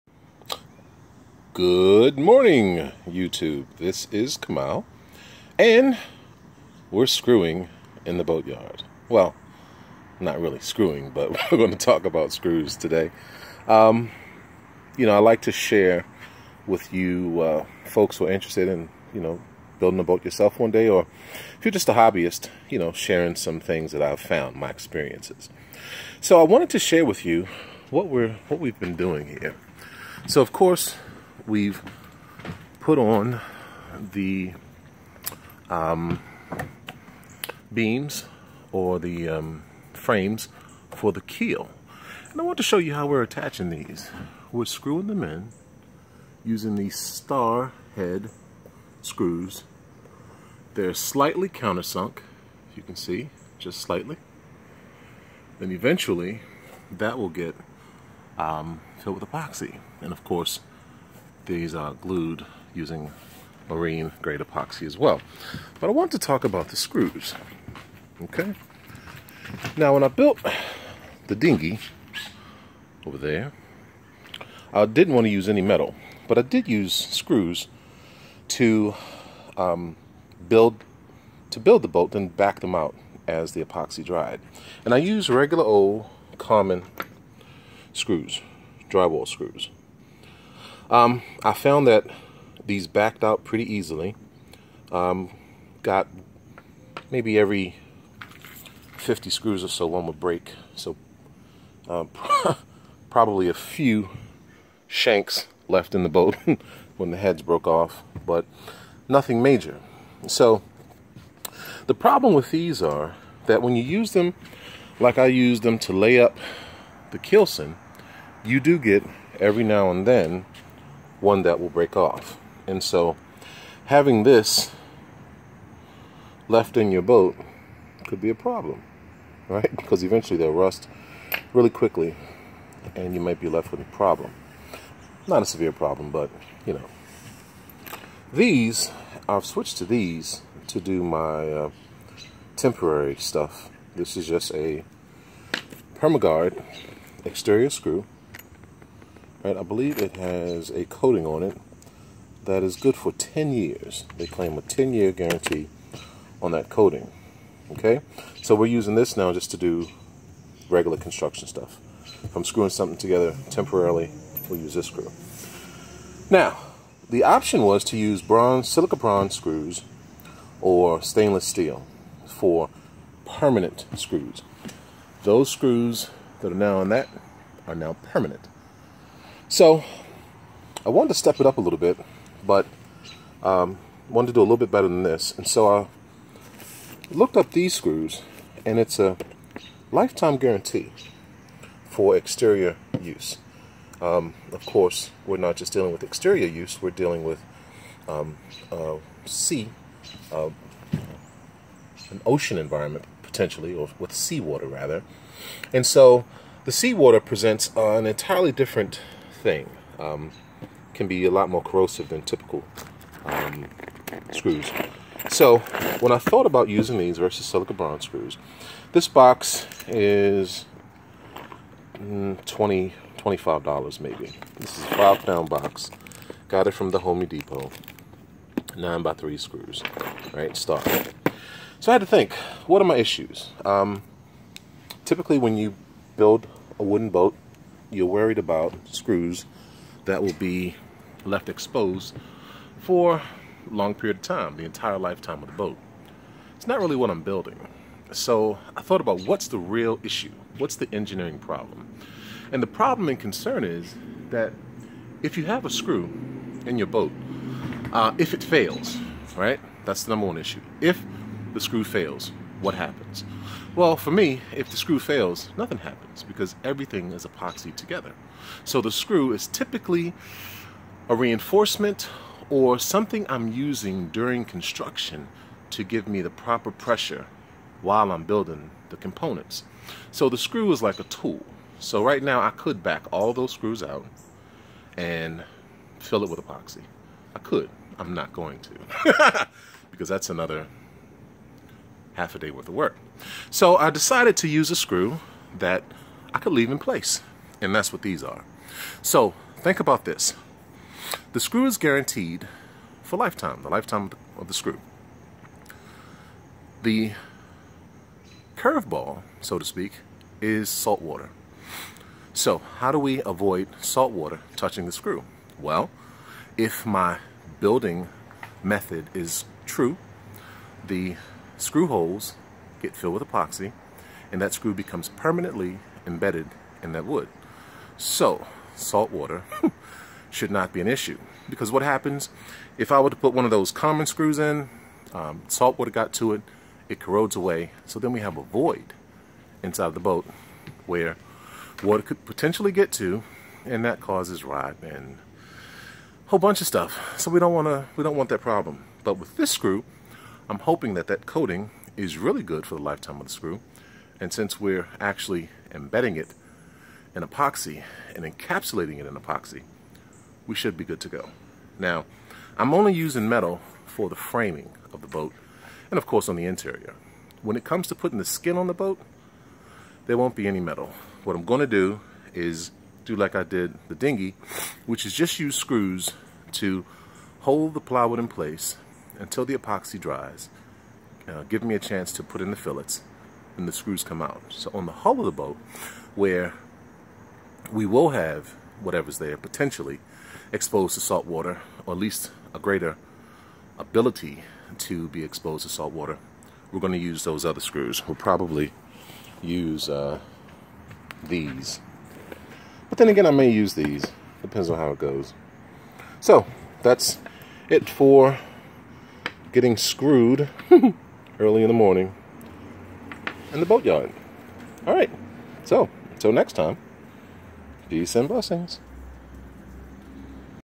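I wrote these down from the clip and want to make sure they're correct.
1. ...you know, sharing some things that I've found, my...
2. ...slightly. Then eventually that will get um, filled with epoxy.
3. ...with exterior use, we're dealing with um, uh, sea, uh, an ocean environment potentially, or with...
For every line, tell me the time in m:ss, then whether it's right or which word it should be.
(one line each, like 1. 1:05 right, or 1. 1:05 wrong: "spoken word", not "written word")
1. 0:22 right
2. 0:53 right
3. 3:15 right.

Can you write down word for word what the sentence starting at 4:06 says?
It's not really what I'm building.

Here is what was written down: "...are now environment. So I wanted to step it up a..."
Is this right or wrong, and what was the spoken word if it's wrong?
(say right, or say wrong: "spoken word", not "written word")
wrong: "permanent", not "environment".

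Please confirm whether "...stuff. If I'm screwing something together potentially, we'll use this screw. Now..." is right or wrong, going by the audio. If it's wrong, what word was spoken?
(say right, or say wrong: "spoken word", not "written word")
wrong: "temporarily", not "potentially".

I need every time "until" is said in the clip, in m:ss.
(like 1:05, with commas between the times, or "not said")
6:19, 6:56.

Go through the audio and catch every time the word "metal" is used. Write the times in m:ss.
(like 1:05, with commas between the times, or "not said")
1:15, 6:03, 6:10.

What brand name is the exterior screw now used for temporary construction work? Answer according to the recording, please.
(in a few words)
PermaGuard.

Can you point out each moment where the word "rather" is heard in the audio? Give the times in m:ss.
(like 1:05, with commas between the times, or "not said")
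3:24.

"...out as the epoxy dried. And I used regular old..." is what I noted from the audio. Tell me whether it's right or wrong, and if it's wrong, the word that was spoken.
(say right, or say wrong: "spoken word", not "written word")
right.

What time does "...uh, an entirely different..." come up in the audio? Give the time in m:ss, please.
3:27.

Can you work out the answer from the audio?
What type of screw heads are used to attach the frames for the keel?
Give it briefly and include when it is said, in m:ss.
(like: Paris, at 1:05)
Star head, at 0:46.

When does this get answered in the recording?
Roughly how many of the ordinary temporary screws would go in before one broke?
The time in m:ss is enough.
1:38.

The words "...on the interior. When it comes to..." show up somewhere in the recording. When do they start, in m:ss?
6:06.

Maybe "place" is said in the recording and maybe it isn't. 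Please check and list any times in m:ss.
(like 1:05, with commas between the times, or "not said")
4:56, 6:18.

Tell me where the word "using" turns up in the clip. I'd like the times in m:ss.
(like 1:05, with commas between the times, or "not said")
0:46, 1:02, 2:38, 3:36, 4:33, 6:02.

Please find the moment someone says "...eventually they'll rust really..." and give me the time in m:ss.
2:10.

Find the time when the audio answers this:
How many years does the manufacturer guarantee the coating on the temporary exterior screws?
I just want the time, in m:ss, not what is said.
2:34.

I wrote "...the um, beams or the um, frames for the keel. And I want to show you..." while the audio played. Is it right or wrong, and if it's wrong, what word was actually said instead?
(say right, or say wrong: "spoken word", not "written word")
right.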